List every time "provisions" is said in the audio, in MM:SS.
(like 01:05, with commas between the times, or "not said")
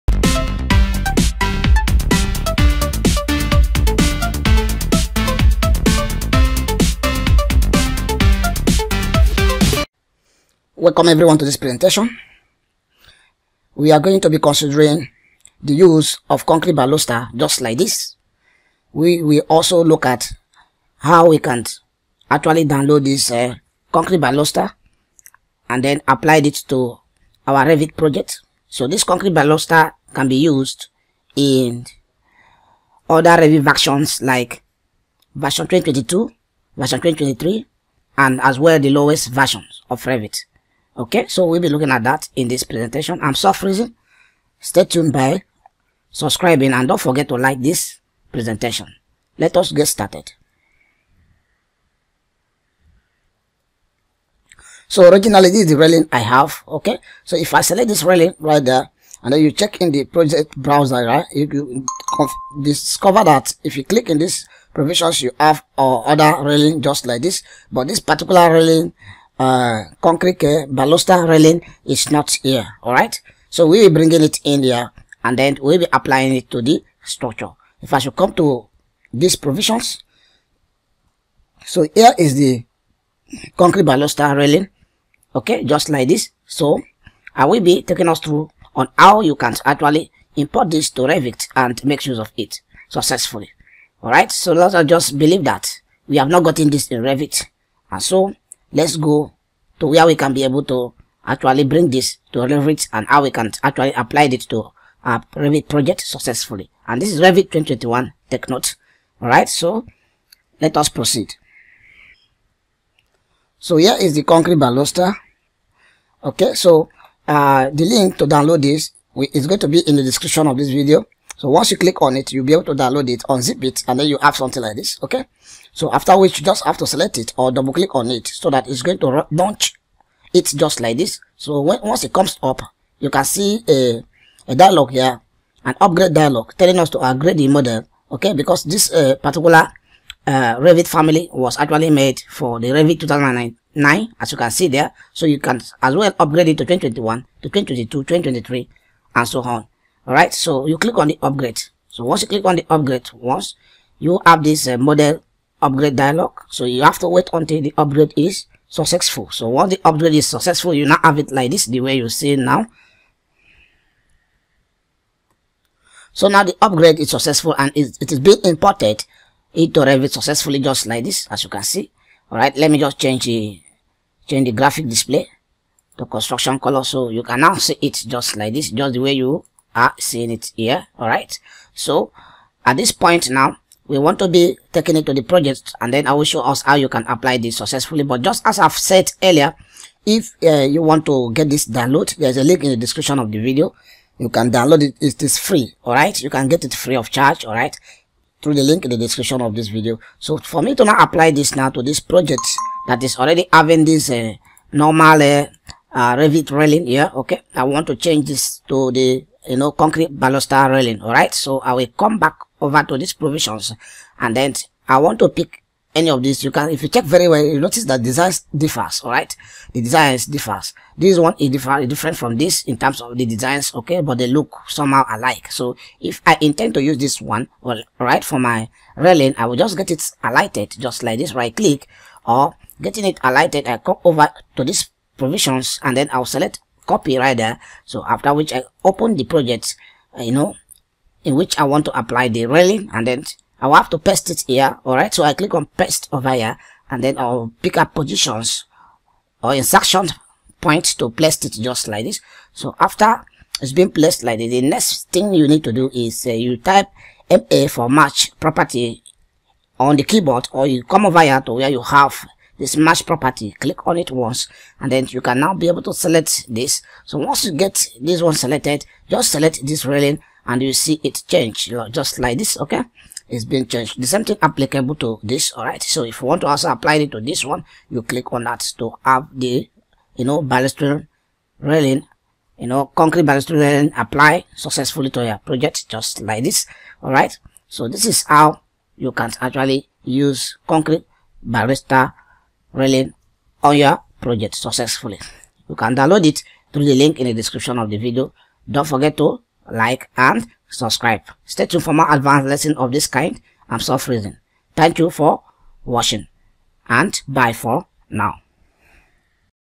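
01:04, 01:19, 03:33, 03:55.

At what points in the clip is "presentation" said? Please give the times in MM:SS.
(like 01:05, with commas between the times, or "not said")
00:11, 00:42, 00:48.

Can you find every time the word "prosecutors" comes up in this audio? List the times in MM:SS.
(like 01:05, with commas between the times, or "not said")
not said.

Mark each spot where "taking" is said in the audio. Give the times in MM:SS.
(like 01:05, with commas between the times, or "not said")
01:27, 03:04.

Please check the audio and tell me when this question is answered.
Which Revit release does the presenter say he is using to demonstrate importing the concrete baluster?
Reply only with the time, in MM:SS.
01:47.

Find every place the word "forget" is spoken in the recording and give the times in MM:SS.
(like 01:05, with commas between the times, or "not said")
00:47, 04:58.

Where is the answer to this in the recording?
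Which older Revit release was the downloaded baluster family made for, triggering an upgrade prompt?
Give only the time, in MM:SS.
02:22.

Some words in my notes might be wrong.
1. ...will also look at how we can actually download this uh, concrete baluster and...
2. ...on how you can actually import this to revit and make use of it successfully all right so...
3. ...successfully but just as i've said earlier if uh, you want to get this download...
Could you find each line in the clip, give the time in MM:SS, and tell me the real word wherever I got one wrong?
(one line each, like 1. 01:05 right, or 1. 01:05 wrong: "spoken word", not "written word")
1. 00:19 right
2. 01:28 right
3. 03:07 right.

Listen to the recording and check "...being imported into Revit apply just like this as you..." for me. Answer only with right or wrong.
wrong.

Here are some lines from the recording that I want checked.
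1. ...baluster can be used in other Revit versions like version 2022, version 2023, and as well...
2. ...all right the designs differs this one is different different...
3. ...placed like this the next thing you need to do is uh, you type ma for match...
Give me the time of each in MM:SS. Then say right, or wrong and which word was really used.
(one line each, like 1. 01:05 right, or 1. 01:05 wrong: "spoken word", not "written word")
1. 00:29 right
2. 03:39 right
3. 04:13 right.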